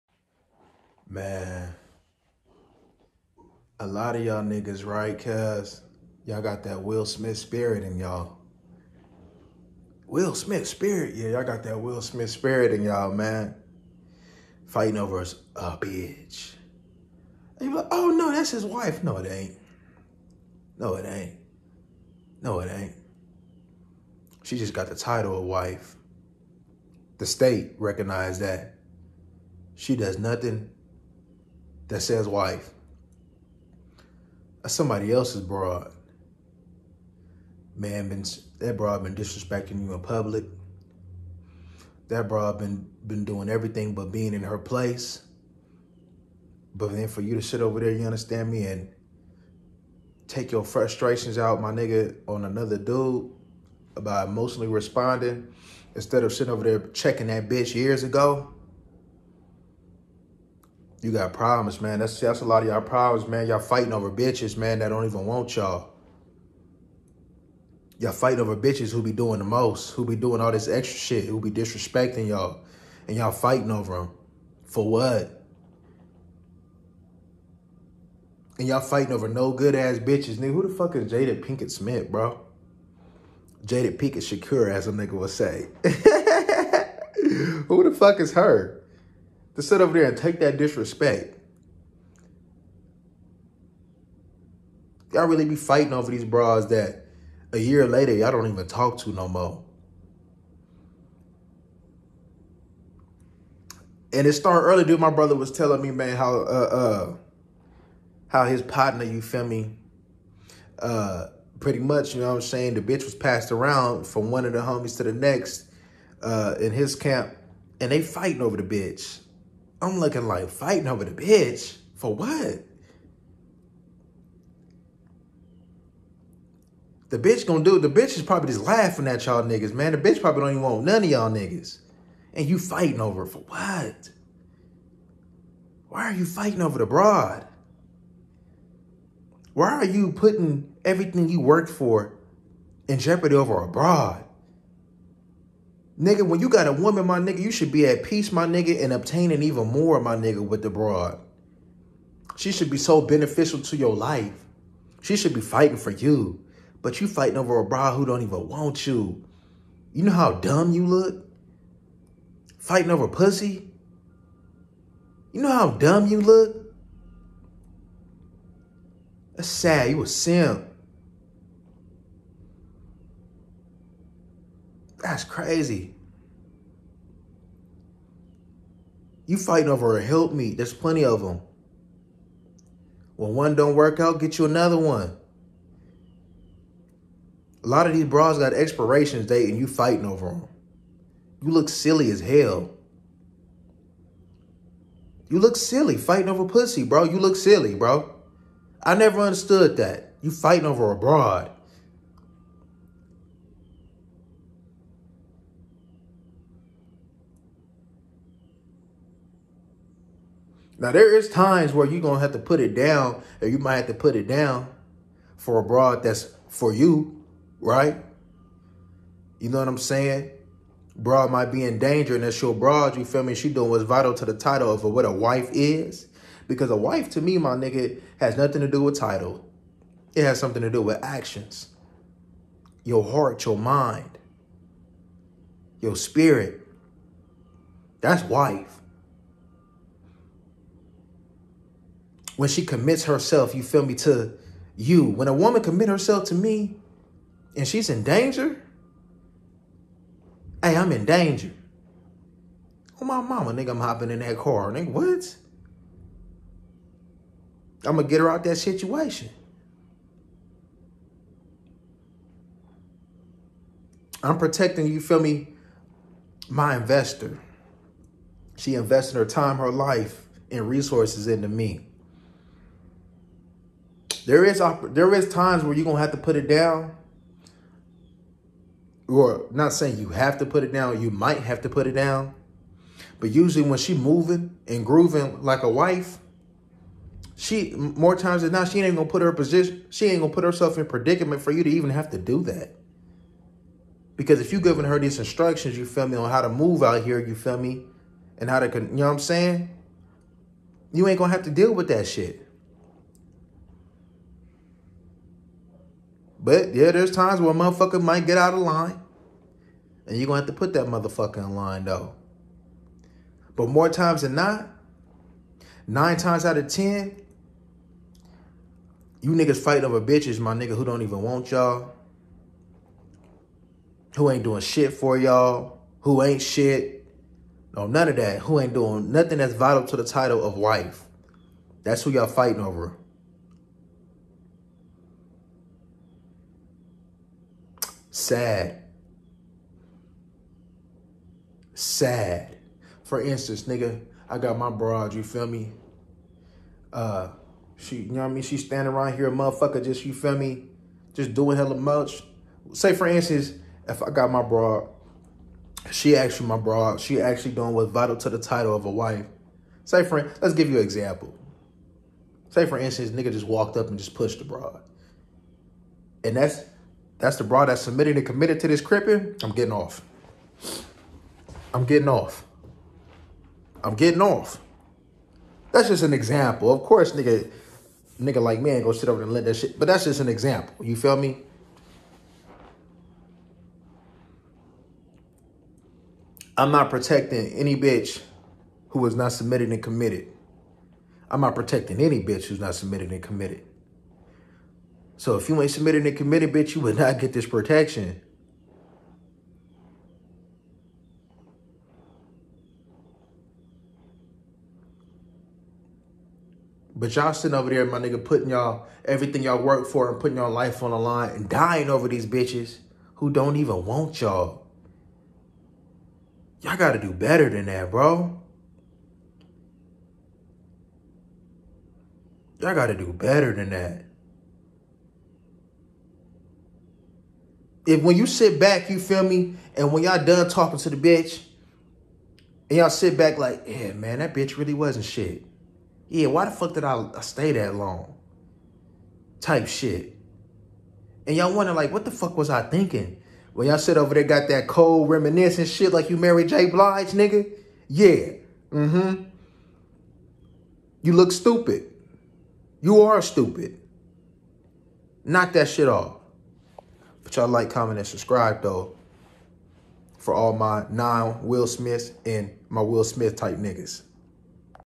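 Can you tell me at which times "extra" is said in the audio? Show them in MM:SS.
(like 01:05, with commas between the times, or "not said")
01:10.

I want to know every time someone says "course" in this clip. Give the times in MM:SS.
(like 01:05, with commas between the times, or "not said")
06:16.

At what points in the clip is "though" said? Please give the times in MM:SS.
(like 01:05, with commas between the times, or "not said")
05:11, 07:38.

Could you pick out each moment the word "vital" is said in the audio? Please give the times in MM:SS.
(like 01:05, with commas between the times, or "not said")
03:43, 05:29, 05:57.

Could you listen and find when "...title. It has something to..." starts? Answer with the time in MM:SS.
03:48.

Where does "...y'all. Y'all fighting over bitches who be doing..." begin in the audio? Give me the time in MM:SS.
01:05.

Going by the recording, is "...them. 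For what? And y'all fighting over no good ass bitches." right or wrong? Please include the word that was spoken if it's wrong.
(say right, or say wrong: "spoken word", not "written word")
right.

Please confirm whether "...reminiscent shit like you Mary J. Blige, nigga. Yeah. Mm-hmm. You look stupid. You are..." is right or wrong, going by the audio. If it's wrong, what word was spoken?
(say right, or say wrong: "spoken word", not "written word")
right.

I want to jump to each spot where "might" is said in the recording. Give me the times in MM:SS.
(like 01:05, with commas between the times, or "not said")
03:33, 03:41, 04:41, 05:08.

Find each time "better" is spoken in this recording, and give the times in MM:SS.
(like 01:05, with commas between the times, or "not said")
06:57, 07:03.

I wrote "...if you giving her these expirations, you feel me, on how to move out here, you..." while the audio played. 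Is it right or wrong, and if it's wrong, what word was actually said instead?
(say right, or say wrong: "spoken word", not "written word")
wrong: "instructions", not "expirations".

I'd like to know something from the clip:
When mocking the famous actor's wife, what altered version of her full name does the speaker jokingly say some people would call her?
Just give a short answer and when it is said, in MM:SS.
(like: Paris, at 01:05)
Jada Pinkett Shakur, at 01:23.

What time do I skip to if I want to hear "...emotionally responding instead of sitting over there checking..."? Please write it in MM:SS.
00:54.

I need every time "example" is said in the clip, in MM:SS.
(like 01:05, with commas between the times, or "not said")
06:00, 06:16, 06:20.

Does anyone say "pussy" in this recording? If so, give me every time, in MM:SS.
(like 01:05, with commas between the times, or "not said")
02:43, 03:16.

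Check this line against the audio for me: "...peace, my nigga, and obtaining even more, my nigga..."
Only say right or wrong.
right.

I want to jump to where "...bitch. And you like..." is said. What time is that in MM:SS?
00:15.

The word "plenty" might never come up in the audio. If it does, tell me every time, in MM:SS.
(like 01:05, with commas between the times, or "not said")
03:00.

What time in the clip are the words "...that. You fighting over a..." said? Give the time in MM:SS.
03:19.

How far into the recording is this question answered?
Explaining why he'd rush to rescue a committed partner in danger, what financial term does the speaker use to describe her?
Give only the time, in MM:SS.
04:26.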